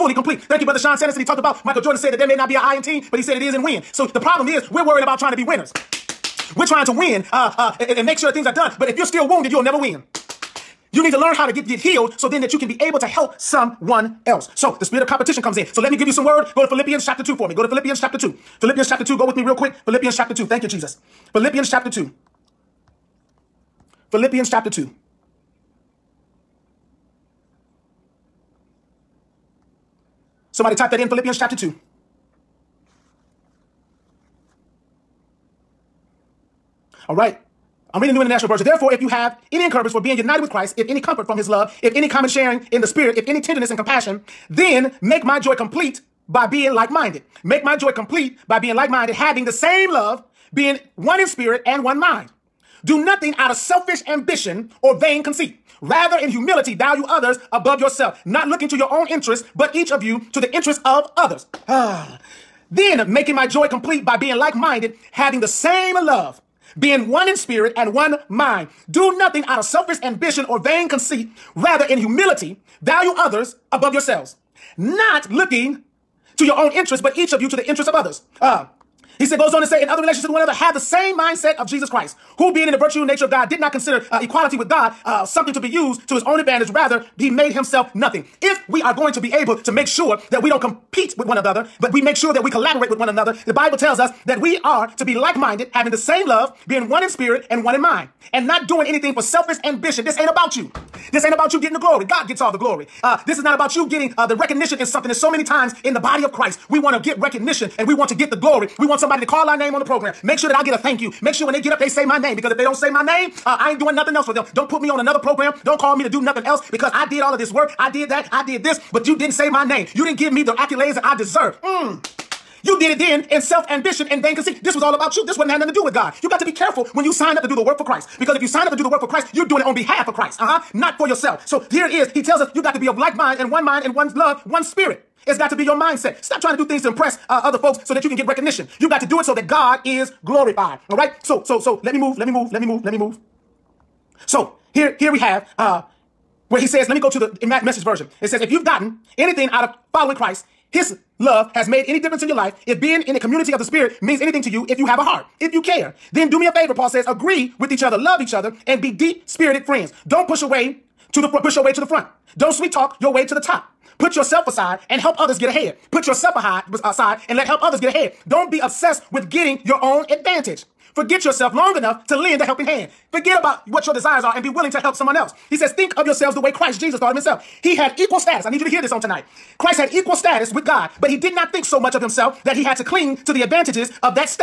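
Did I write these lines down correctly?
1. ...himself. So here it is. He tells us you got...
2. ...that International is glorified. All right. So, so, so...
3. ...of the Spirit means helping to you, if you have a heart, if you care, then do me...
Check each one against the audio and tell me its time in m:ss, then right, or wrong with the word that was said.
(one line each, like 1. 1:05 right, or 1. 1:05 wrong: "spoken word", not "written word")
1. 2:11 wrong: "yourself", not "himself"
2. 2:19 wrong: "God", not "International"
3. 2:33 wrong: "anything", not "helping".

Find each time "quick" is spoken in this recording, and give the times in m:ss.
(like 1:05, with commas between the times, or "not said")
0:19.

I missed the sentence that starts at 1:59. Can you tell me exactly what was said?
You didn't give me the accolades that I deserve.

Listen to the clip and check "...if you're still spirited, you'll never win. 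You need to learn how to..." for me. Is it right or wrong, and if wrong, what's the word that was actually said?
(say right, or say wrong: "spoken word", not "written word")
wrong: "wounded", not "spirited".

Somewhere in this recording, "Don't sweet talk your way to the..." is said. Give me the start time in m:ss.
2:42.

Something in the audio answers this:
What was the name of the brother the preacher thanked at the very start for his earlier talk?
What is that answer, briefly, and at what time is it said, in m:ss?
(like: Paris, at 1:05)
Sean Sanderson, at 0:00.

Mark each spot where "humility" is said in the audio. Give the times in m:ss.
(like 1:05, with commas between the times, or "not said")
0:56, 1:11.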